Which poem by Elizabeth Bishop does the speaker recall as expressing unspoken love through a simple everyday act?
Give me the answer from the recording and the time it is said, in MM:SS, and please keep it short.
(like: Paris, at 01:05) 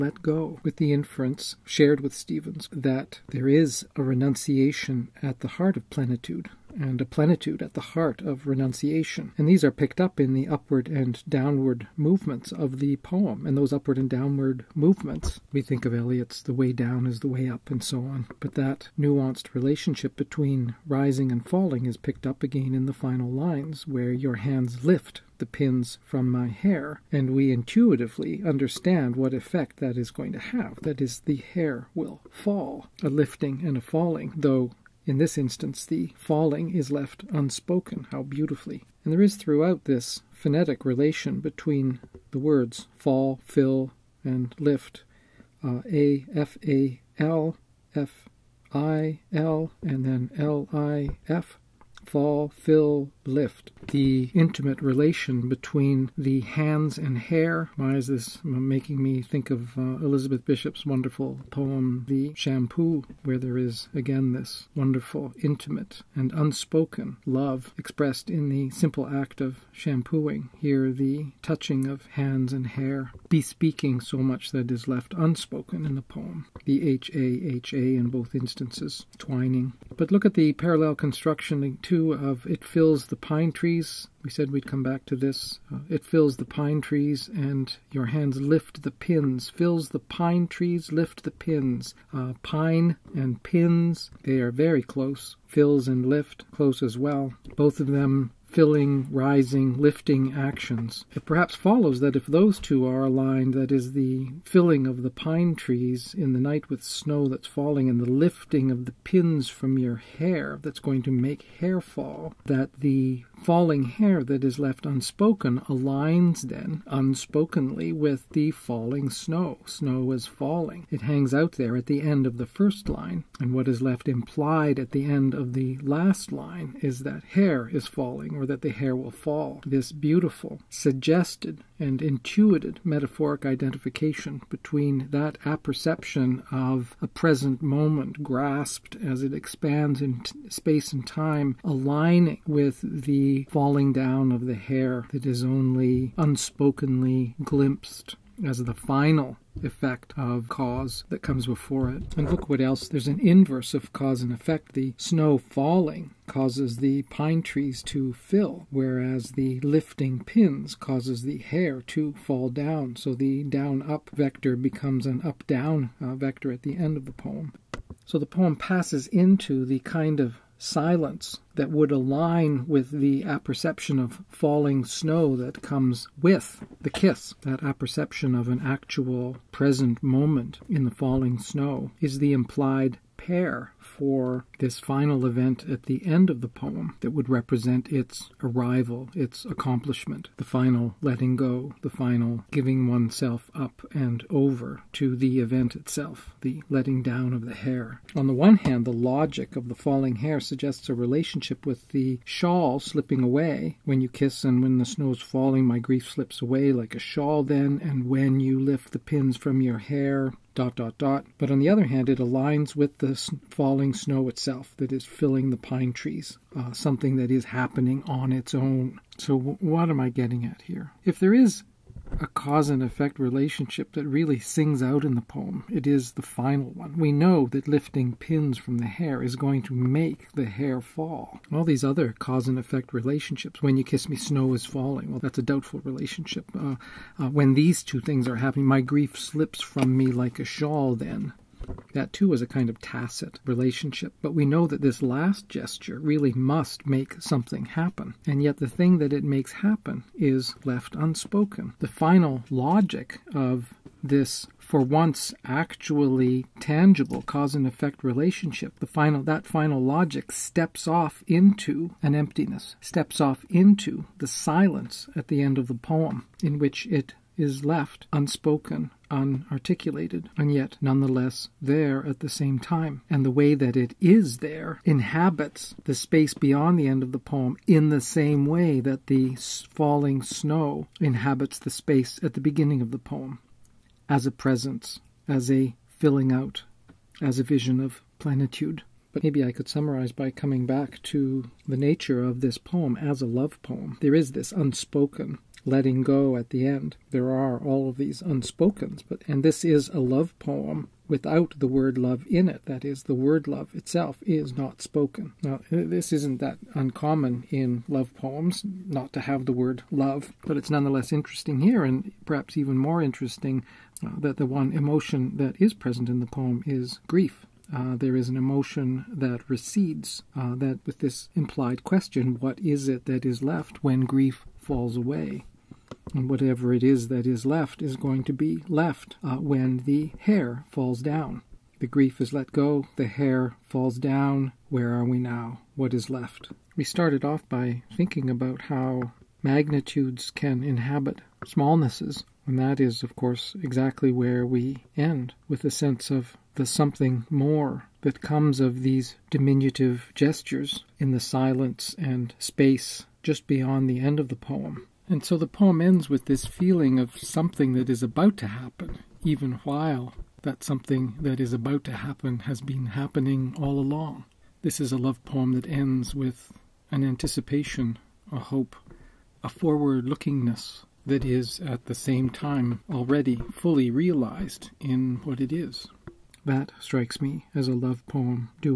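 The Shampoo, at 01:02.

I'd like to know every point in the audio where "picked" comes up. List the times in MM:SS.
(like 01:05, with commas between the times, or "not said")
00:09, 00:21.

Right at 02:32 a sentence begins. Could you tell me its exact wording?
And look what else there's an inverse of cause and effect.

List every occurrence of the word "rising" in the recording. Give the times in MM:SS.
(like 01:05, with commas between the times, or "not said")
00:20, 01:39.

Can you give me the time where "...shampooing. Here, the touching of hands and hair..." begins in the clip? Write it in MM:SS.
01:09.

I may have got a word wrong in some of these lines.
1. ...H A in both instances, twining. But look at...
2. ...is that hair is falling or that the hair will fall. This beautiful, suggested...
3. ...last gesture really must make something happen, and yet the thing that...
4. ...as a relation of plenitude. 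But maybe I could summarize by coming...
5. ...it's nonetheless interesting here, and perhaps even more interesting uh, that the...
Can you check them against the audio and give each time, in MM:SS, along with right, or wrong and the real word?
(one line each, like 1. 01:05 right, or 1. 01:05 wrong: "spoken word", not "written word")
1. 01:17 right
2. 02:06 right
3. 04:05 right
4. 04:47 wrong: "vision", not "relation"
5. 05:10 right.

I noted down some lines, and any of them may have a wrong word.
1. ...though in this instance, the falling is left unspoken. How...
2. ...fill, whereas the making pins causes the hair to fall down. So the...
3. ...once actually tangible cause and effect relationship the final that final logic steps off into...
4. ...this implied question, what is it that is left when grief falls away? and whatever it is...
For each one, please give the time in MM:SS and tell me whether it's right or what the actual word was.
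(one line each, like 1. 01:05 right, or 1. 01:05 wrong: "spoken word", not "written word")
1. 00:34 right
2. 02:38 wrong: "lifting", not "making"
3. 04:14 right
4. 05:20 right.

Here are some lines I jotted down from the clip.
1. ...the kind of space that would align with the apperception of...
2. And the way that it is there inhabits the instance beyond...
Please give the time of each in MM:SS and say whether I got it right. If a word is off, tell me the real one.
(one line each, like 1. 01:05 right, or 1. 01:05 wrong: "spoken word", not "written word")
1. 02:49 wrong: "silence", not "space"
2. 04:33 wrong: "space", not "instance".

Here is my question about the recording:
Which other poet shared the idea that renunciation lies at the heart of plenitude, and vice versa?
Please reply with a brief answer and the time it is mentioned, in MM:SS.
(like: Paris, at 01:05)
Stevens, at 00:02.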